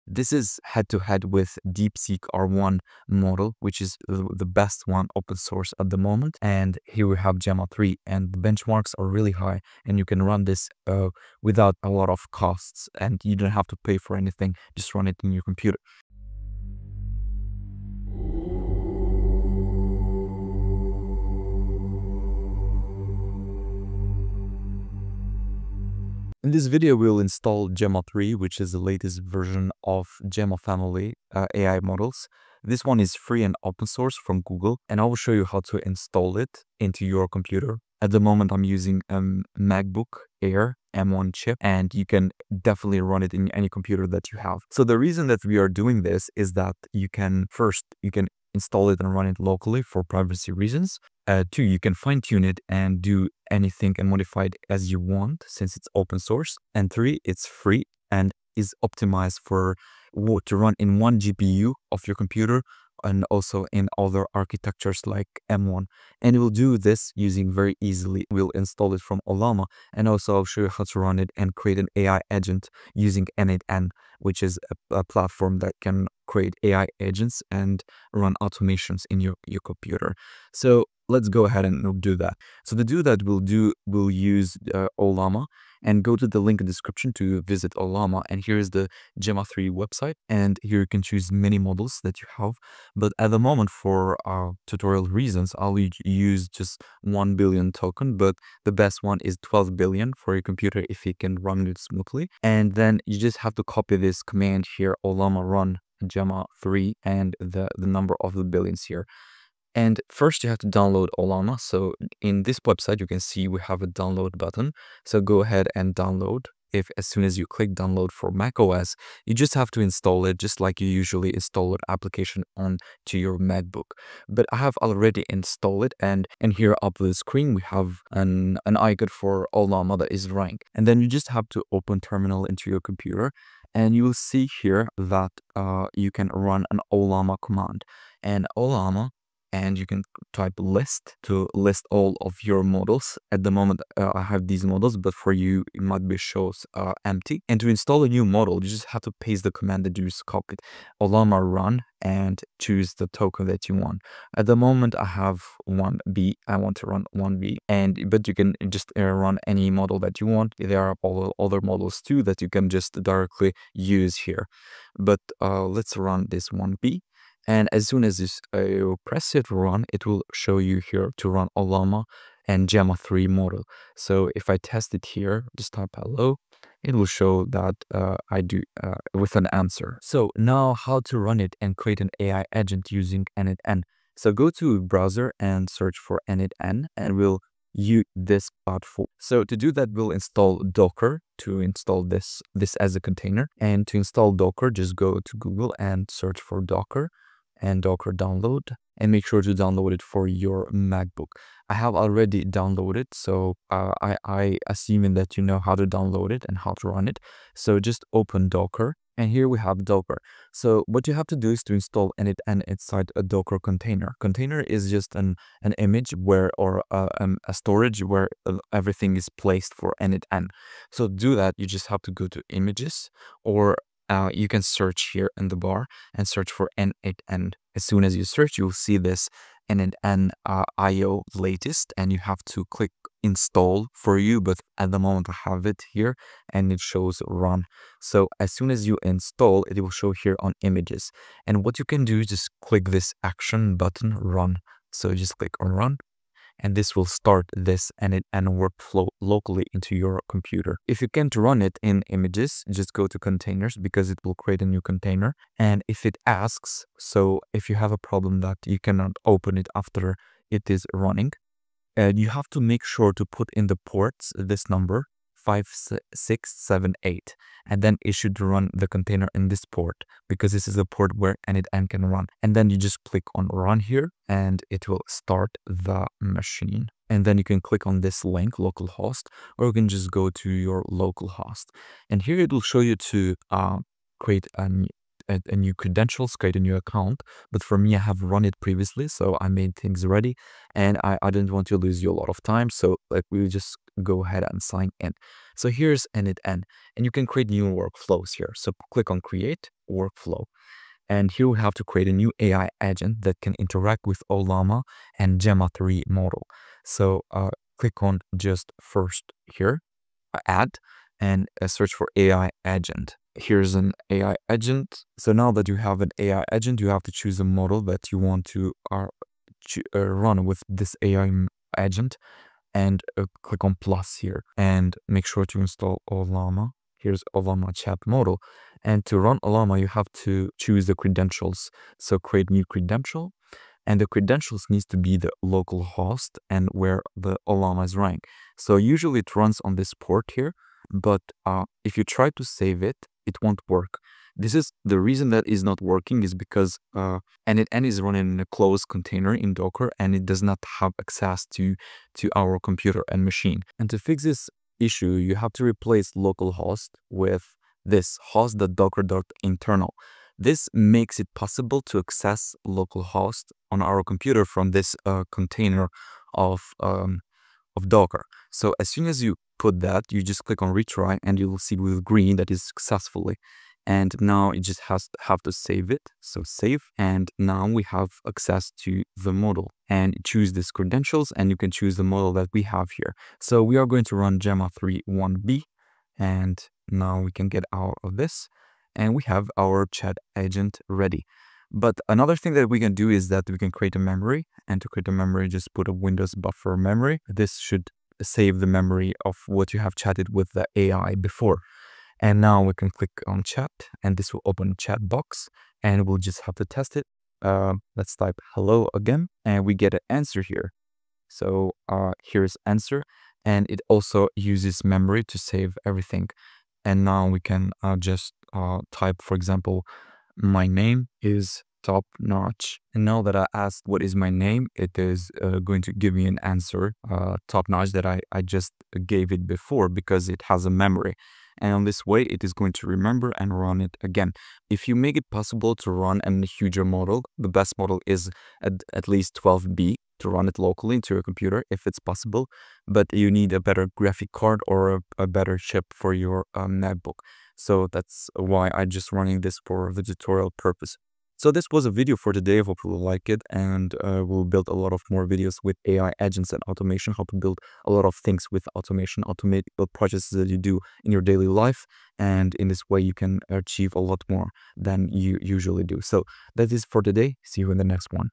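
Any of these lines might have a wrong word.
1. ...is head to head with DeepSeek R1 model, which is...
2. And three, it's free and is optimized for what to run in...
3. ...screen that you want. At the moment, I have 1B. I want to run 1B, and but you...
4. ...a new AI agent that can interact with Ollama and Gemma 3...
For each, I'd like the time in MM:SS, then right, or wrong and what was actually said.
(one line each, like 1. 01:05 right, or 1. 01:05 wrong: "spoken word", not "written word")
1. 00:00 right
2. 00:56 right
3. 02:33 wrong: "token", not "screen"
4. 05:02 right.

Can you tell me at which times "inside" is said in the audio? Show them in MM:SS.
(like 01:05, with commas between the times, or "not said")
03:32.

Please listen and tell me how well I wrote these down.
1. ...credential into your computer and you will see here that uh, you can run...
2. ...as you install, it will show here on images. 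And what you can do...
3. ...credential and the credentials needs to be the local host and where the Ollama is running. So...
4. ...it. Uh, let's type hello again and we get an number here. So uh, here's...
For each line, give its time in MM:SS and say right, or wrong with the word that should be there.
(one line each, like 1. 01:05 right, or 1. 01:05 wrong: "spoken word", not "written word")
1. 02:11 wrong: "terminal", not "credential"
2. 03:58 right
3. 05:32 right
4. 06:46 wrong: "answer", not "number".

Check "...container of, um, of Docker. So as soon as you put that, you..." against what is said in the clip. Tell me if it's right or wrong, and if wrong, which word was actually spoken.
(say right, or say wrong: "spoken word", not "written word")
right.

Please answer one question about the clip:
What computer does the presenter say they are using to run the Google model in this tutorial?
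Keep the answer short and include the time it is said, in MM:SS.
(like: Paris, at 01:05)
MacBook Air M1, at 00:39.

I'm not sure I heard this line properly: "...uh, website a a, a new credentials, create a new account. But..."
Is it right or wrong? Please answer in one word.
wrong.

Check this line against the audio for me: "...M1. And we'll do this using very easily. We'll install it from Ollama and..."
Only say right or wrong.
right.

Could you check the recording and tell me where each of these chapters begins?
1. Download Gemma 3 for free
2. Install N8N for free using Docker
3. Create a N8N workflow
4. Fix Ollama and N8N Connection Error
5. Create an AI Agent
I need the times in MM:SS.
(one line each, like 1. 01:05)
1. 01:22
2. 03:00
3. 04:57
4. 05:28
5. 06:16.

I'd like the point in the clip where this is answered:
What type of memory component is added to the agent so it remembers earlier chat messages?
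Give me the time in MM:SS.
06:36.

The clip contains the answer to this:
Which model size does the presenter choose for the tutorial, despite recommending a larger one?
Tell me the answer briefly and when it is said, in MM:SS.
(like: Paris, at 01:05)
1 billion, at 01:37.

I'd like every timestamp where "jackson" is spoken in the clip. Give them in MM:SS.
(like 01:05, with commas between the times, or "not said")
not said.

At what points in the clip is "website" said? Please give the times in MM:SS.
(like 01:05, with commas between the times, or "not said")
01:29, 01:52.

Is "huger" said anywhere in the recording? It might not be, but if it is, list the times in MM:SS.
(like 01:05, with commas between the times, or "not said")
07:16.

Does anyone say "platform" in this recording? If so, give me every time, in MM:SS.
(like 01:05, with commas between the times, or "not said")
01:15, 03:08.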